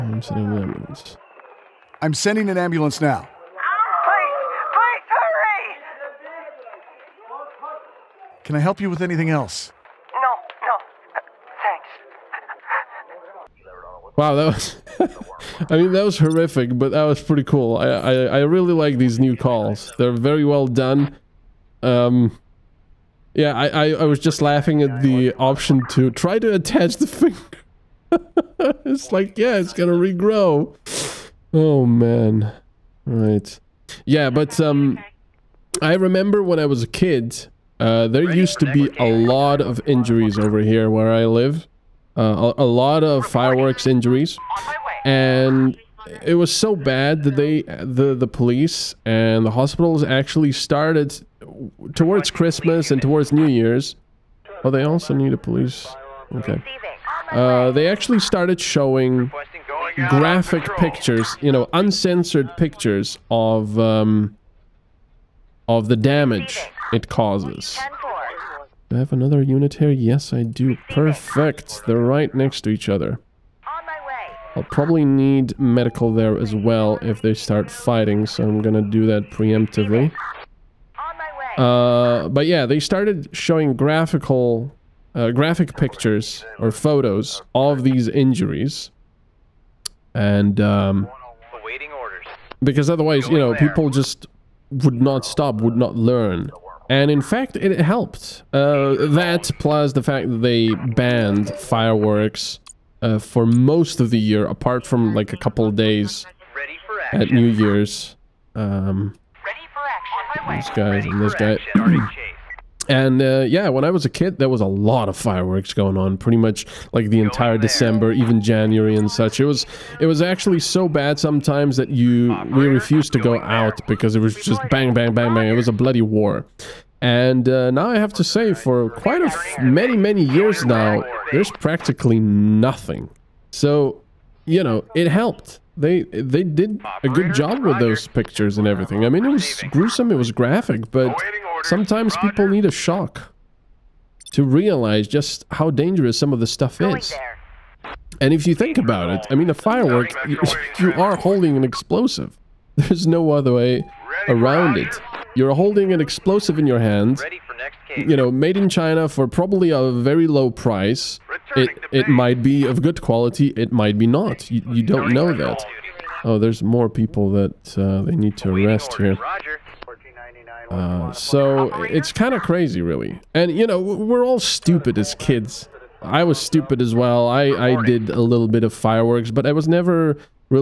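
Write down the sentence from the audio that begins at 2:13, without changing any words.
So, you know, it helped they they did a good job with those pictures and everything.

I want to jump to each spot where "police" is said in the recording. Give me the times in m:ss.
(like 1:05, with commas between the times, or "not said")
0:48, 0:55.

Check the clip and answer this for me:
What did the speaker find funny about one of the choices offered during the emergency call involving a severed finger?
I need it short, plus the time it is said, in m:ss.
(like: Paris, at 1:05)
try to attach the finger, at 0:26.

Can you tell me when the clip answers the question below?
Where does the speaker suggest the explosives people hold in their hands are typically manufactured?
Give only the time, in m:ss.
2:38.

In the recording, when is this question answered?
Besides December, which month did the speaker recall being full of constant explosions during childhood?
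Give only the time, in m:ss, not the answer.
1:58.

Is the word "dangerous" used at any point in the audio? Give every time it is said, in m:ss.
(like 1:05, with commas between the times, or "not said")
2:25.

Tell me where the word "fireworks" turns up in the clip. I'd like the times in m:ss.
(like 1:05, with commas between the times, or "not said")
0:43, 1:41, 1:55, 2:29, 2:58.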